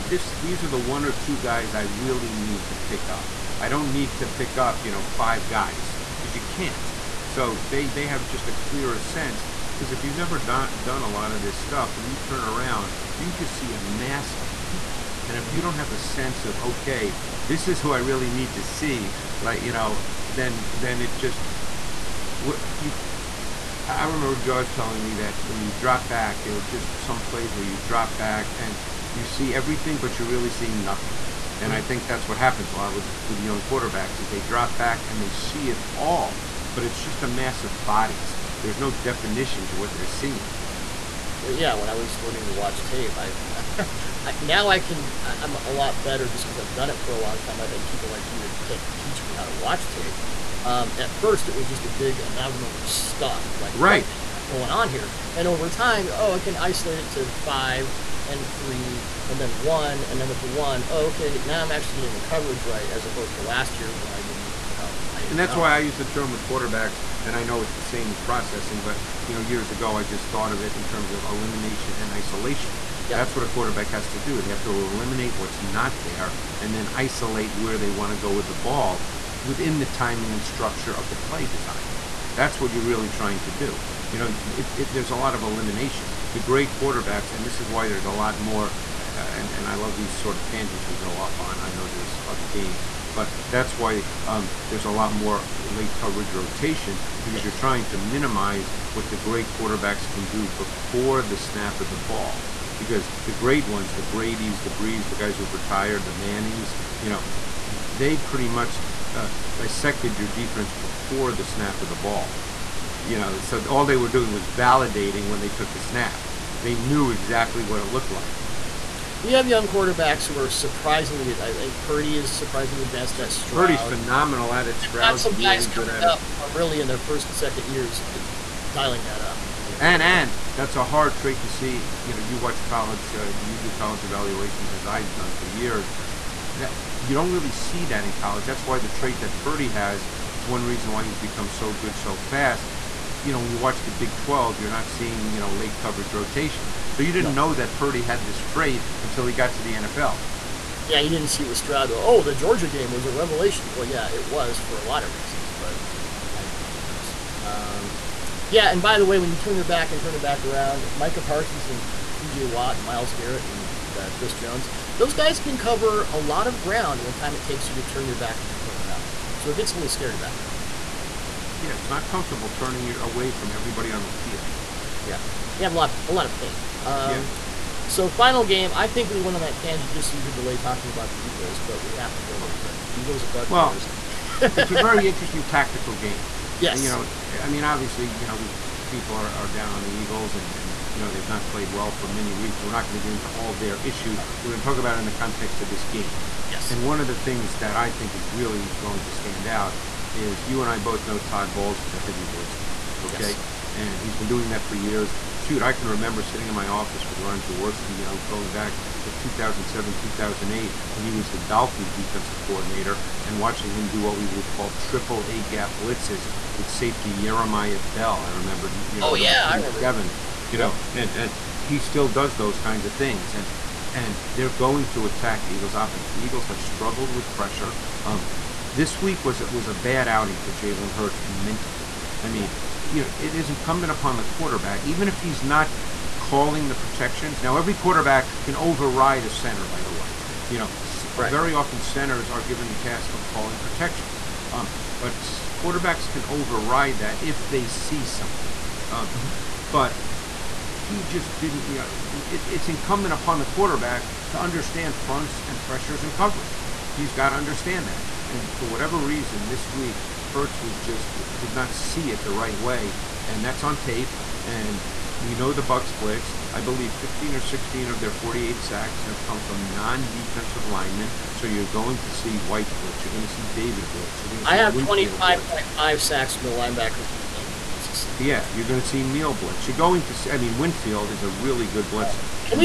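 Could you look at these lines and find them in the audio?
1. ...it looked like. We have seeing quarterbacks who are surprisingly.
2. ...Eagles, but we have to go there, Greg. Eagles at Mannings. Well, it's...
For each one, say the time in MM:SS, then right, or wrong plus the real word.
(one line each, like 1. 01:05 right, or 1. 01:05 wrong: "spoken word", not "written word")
1. 01:57 wrong: "young", not "seeing"
2. 03:01 wrong: "Buccaneers", not "Mannings".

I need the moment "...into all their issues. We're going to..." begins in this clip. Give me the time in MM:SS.
03:13.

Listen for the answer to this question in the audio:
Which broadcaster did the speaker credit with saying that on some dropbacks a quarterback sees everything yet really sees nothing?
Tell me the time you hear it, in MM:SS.
00:24.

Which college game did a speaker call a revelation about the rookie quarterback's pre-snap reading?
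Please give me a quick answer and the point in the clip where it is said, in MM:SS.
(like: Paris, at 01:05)
the Georgia game, at 02:32.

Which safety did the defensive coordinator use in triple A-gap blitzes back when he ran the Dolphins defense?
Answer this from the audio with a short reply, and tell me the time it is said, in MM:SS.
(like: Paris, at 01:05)
Yeremiah Bell, at 03:37.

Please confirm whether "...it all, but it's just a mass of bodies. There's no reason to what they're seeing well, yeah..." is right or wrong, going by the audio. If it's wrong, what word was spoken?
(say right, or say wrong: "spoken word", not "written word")
wrong: "definition", not "reason".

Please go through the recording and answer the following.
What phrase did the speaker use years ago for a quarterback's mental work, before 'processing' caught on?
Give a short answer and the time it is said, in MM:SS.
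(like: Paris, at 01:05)
elimination and isolation, at 01:11.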